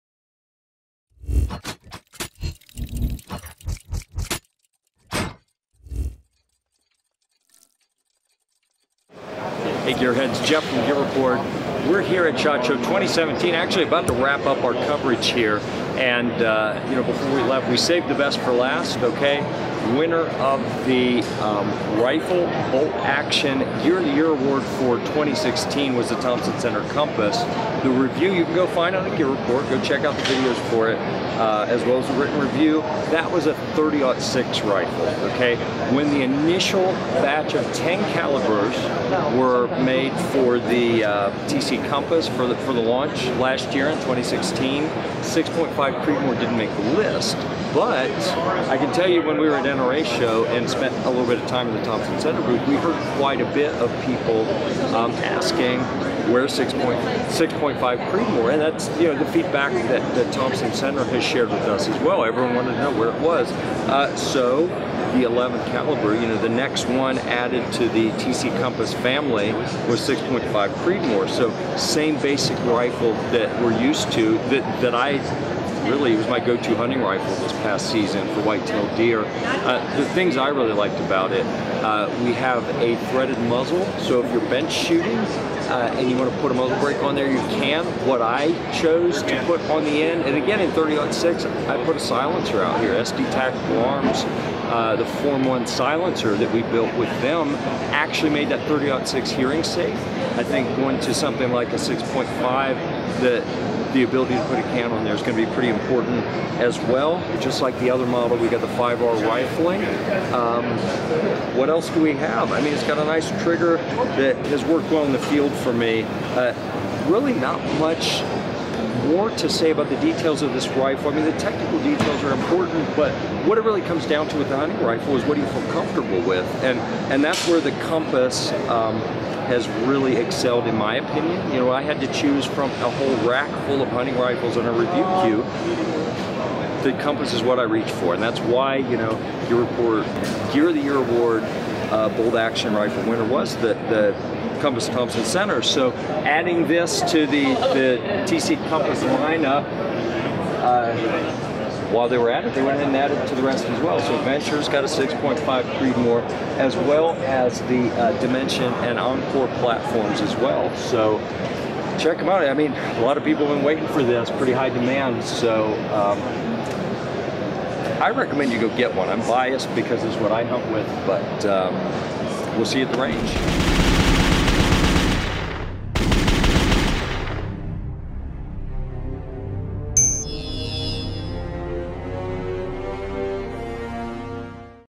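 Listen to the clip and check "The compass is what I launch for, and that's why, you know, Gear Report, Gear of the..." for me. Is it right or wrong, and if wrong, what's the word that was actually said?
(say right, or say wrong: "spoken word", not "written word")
wrong: "reach", not "launch".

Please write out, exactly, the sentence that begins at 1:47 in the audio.
Just like the other model, we got the 5R rifling.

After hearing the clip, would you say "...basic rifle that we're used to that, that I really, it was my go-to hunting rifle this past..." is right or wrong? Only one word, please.
right.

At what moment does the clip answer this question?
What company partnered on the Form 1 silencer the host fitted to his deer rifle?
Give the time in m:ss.
1:32.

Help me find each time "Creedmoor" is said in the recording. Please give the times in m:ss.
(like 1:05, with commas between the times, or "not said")
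0:46, 0:58, 1:10, 2:35.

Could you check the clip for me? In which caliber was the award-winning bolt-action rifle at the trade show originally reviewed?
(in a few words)
30-06.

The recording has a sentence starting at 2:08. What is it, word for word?
Um, has really excelled in my opinion.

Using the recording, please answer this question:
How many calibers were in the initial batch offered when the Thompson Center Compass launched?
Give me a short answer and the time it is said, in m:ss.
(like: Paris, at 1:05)
10, at 0:36.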